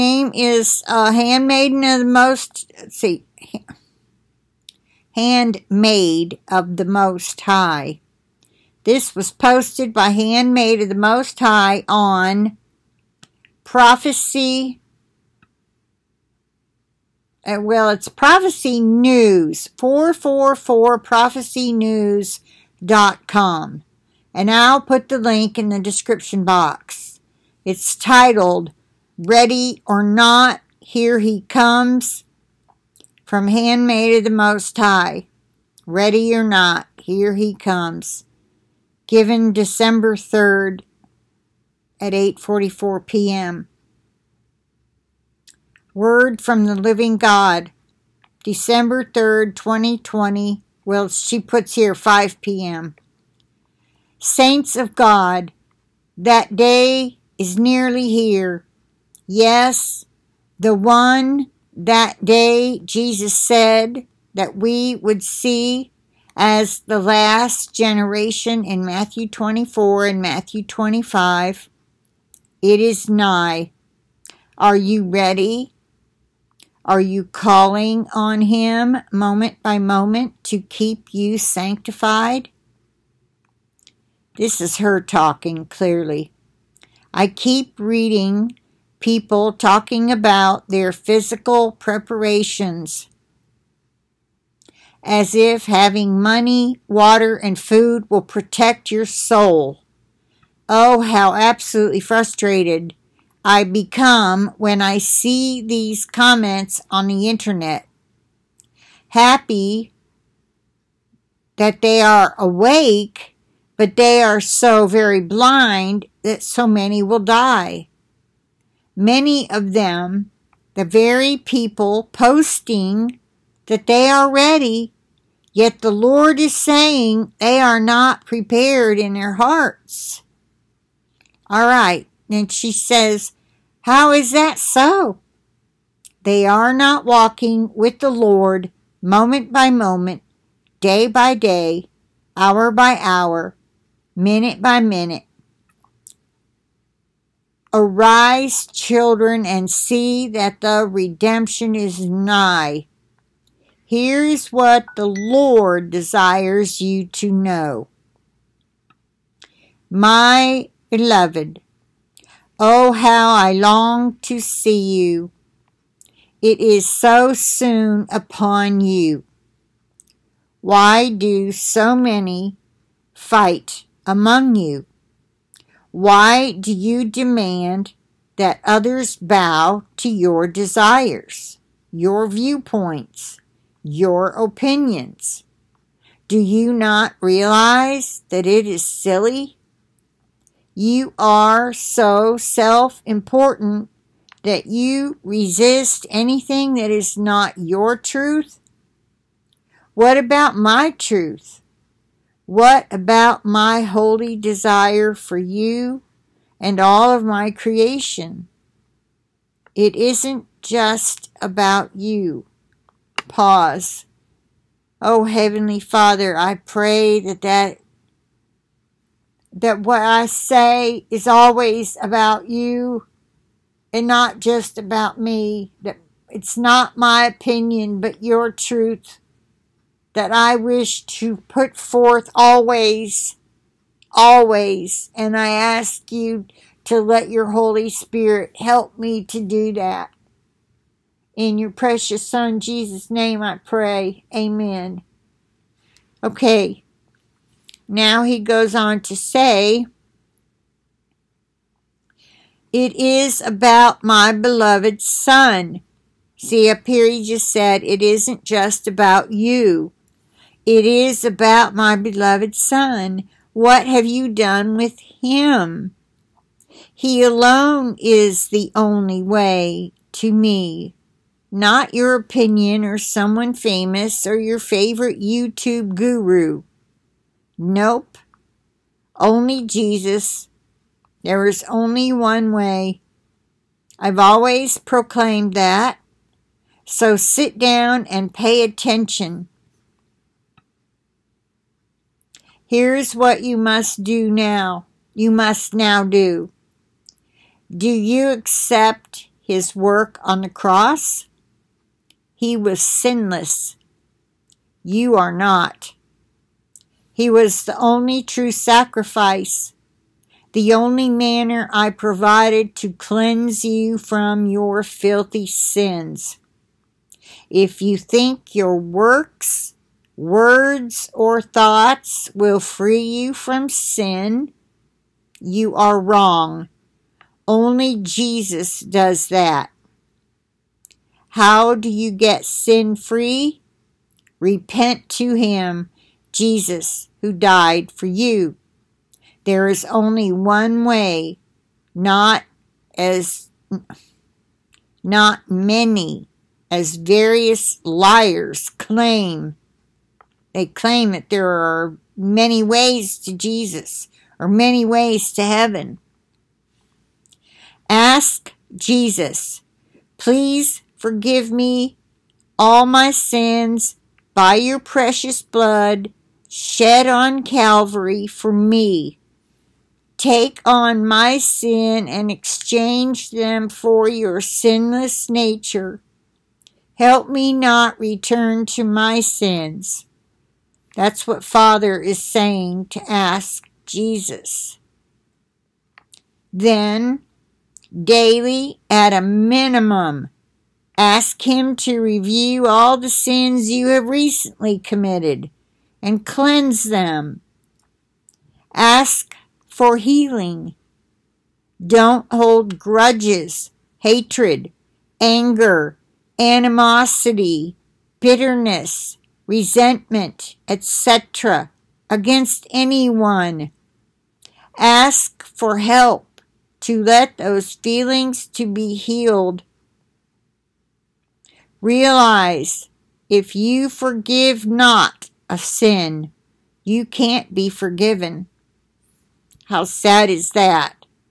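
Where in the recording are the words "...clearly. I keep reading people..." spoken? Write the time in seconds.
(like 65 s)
85 s.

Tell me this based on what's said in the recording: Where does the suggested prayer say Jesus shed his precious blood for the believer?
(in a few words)
Calvary.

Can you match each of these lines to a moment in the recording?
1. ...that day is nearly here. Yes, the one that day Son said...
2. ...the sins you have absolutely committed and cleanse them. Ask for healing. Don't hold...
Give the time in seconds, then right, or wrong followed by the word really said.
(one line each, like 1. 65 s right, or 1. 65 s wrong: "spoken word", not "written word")
1. 56 s wrong: "Jesus", not "Son"
2. 392 s wrong: "recently", not "absolutely".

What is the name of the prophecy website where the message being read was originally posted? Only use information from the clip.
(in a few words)
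444prophecynews.com.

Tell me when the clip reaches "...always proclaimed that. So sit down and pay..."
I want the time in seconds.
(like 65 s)
284 s.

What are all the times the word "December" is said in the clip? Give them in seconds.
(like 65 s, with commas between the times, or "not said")
39 s, 48 s.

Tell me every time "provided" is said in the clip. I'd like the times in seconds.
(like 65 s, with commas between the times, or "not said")
311 s.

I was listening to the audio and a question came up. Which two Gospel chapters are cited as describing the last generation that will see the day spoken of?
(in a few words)
Matthew 24 and Matthew 25.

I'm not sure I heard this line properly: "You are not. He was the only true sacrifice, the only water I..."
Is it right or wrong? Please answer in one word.
wrong.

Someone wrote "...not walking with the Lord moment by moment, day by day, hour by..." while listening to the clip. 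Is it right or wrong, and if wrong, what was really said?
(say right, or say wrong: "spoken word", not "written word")
right.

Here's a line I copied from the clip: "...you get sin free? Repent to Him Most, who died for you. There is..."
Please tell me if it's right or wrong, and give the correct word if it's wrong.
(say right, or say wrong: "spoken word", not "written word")
wrong: "Jesus", not "Most".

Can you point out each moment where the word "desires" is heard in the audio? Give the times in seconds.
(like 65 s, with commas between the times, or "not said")
155 s, 180 s, 204 s.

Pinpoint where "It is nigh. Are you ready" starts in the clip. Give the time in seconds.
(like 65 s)
72 s.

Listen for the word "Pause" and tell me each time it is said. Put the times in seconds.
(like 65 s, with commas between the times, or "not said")
213 s.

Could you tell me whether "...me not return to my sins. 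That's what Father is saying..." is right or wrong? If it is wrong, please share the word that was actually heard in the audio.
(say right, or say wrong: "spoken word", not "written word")
right.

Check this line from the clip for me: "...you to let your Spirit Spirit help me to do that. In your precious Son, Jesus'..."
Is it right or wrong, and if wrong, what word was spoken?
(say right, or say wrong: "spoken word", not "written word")
wrong: "Holy", not "Spirit".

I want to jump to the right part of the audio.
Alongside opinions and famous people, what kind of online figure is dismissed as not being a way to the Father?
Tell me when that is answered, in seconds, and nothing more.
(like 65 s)
275 s.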